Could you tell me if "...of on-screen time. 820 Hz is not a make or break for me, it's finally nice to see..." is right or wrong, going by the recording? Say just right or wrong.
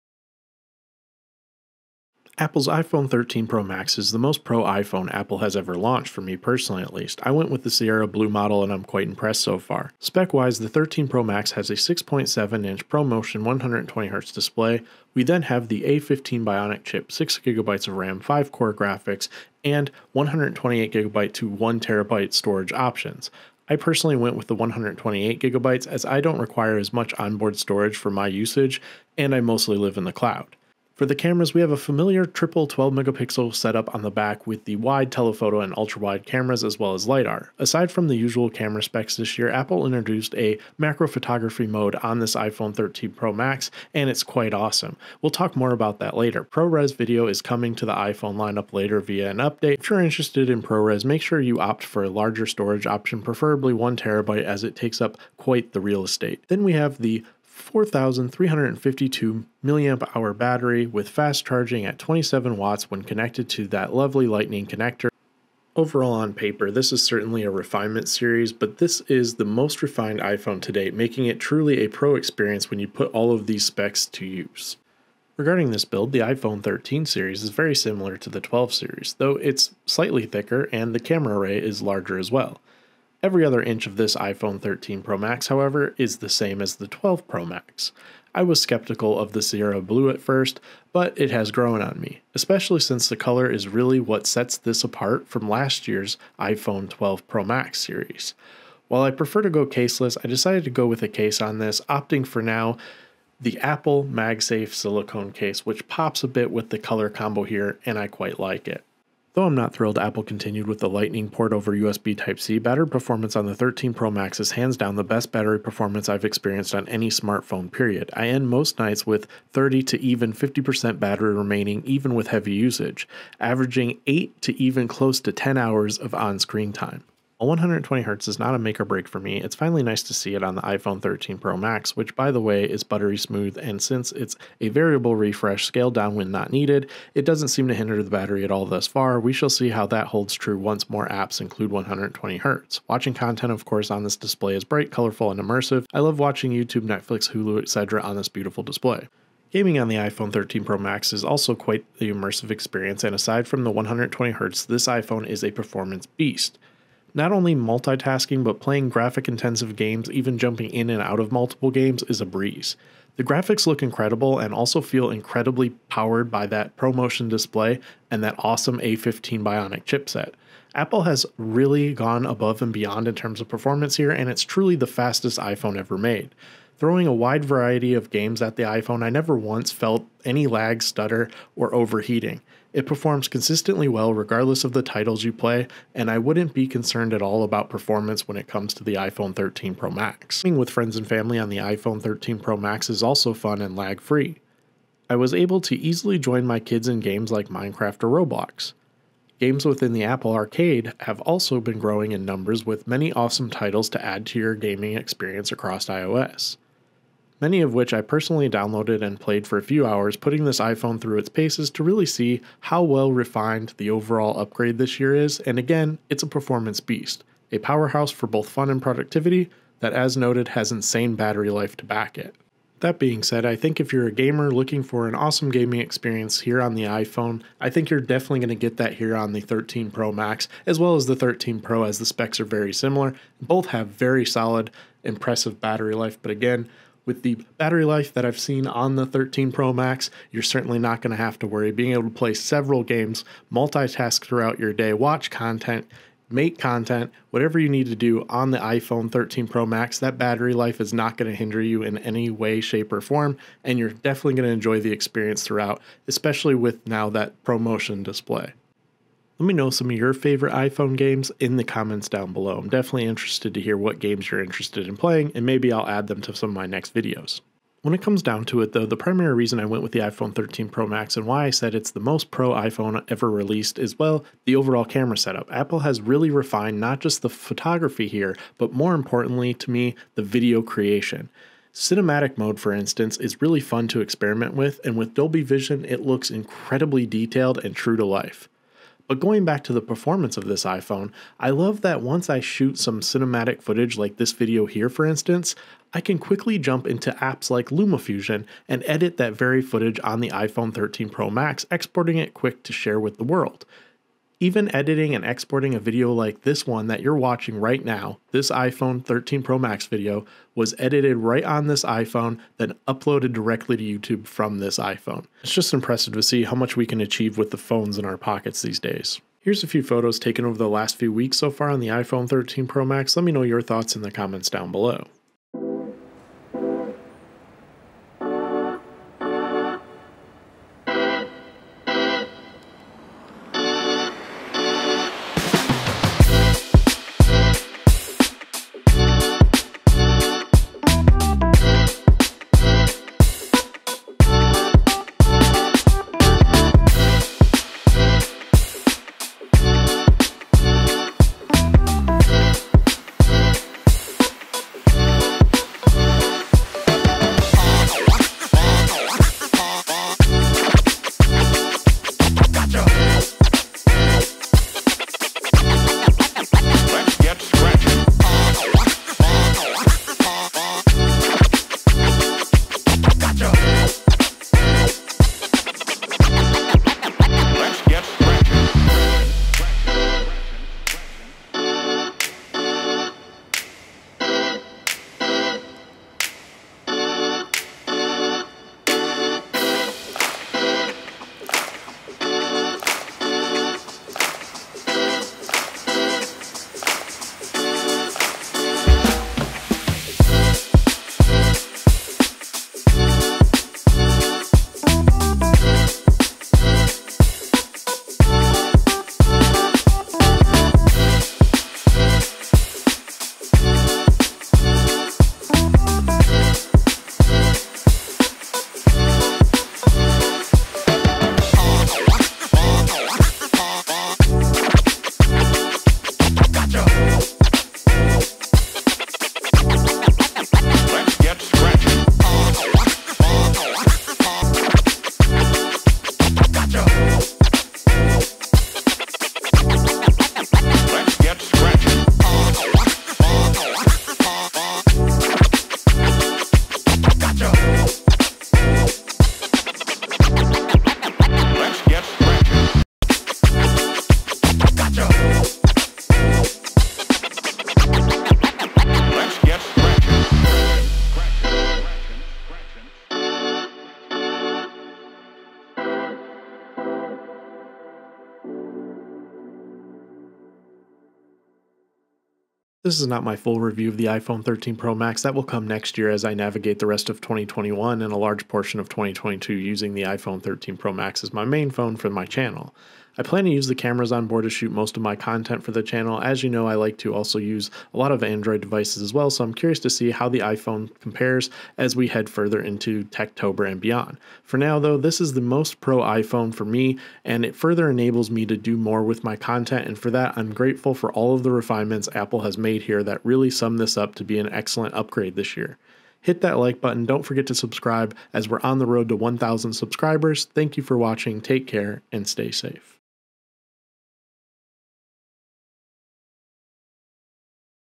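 wrong.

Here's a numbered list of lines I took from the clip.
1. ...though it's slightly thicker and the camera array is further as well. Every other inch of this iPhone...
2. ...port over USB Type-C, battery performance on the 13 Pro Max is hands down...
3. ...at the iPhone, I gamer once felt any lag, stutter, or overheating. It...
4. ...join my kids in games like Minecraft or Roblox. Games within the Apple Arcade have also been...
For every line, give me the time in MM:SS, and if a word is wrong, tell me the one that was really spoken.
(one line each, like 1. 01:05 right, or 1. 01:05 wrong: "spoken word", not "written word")
1. 01:19 wrong: "larger", not "further"
2. 01:51 right
3. 02:58 wrong: "never", not "gamer"
4. 03:16 right.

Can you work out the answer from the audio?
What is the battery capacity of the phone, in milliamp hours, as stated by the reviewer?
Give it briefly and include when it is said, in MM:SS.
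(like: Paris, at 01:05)
4,352, at 00:57.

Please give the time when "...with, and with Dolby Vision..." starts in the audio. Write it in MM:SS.
04:44.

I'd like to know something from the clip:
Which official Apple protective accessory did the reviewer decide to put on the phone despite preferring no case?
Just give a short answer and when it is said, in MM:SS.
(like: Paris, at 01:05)
Apple MagSafe silicone case, at 01:43.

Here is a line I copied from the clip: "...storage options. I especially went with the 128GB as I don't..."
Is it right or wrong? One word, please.
wrong.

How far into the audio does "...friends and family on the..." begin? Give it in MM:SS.
03:10.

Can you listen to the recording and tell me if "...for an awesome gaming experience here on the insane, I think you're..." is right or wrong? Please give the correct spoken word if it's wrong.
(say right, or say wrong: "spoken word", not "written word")
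wrong: "iPhone", not "insane".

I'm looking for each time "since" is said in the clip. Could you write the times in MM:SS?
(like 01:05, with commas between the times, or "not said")
01:32, 02:13.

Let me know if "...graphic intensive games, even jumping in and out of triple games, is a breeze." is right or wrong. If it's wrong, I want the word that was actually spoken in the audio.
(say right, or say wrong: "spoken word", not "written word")
wrong: "multiple", not "triple".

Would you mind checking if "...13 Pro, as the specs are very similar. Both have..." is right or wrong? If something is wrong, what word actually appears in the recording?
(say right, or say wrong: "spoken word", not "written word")
right.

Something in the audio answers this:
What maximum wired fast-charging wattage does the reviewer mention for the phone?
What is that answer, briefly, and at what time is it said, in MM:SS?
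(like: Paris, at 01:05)
27 watts, at 01:01.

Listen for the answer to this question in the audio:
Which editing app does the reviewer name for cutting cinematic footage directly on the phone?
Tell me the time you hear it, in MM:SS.
04:57.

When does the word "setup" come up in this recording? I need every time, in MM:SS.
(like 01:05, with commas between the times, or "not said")
00:33, 04:35.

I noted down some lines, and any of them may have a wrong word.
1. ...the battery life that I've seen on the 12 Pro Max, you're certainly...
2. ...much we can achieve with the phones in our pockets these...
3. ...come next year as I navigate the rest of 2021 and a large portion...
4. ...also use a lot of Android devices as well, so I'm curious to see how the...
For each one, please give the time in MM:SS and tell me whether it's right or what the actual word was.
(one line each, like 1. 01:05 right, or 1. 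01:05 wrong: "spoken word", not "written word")
1. 03:57 wrong: "13", not "12"
2. 05:16 right
3. 07:55 right
4. 08:07 right.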